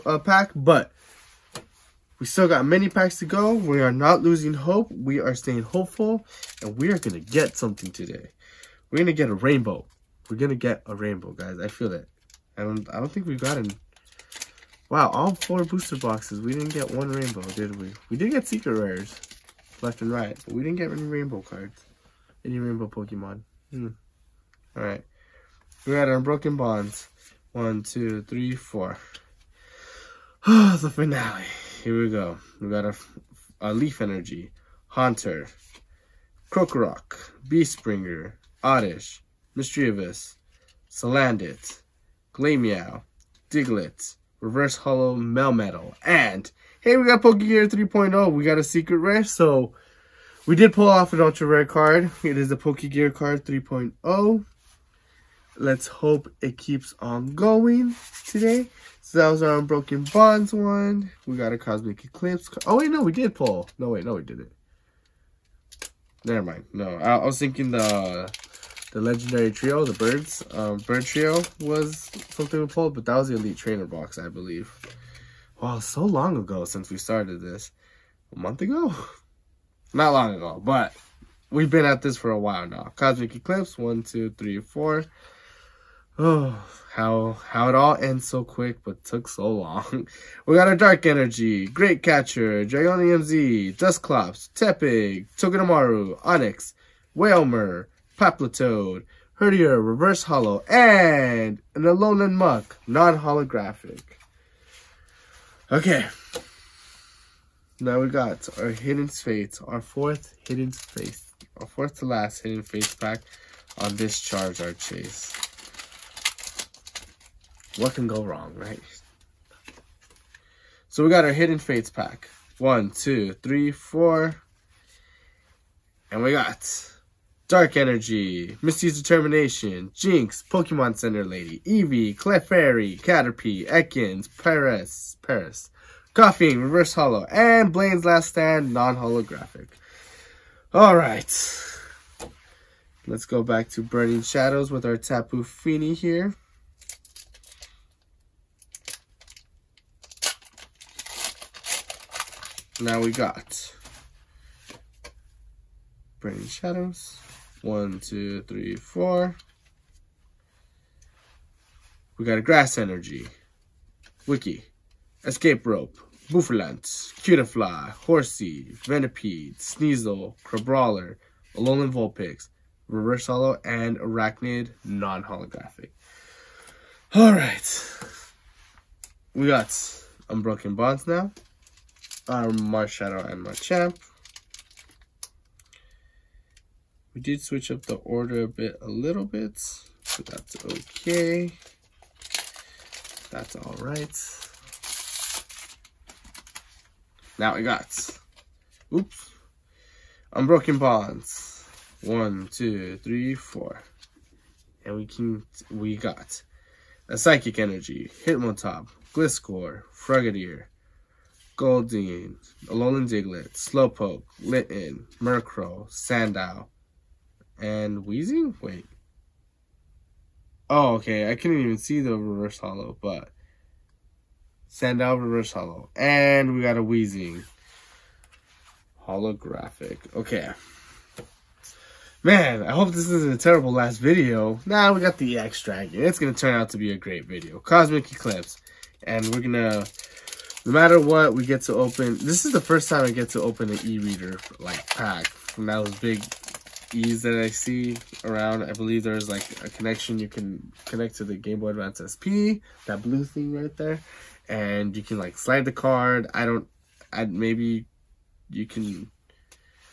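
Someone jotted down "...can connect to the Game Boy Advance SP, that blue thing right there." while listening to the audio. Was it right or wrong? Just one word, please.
right.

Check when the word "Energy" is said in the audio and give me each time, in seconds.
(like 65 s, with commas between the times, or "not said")
34 s, 91 s, 127 s, 162 s, 207 s.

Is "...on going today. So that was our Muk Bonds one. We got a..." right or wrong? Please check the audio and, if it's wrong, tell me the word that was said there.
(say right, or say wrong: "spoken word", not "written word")
wrong: "Unbroken", not "Muk".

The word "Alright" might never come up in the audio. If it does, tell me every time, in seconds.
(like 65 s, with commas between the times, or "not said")
24 s, 140 s.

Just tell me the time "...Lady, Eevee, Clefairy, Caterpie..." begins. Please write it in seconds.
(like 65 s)
131 s.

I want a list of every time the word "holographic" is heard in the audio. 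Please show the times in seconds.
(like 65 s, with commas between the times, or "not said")
102 s, 138 s, 174 s, 229 s.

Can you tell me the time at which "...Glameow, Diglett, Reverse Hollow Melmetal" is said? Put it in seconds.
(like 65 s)
42 s.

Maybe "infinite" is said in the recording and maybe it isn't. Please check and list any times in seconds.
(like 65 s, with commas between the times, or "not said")
not said.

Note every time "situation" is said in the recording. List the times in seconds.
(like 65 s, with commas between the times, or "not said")
not said.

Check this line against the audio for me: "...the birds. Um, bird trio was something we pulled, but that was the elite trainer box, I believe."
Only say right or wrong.
right.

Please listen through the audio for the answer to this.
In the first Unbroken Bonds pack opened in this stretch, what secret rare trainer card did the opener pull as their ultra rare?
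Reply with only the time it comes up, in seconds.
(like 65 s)
52 s.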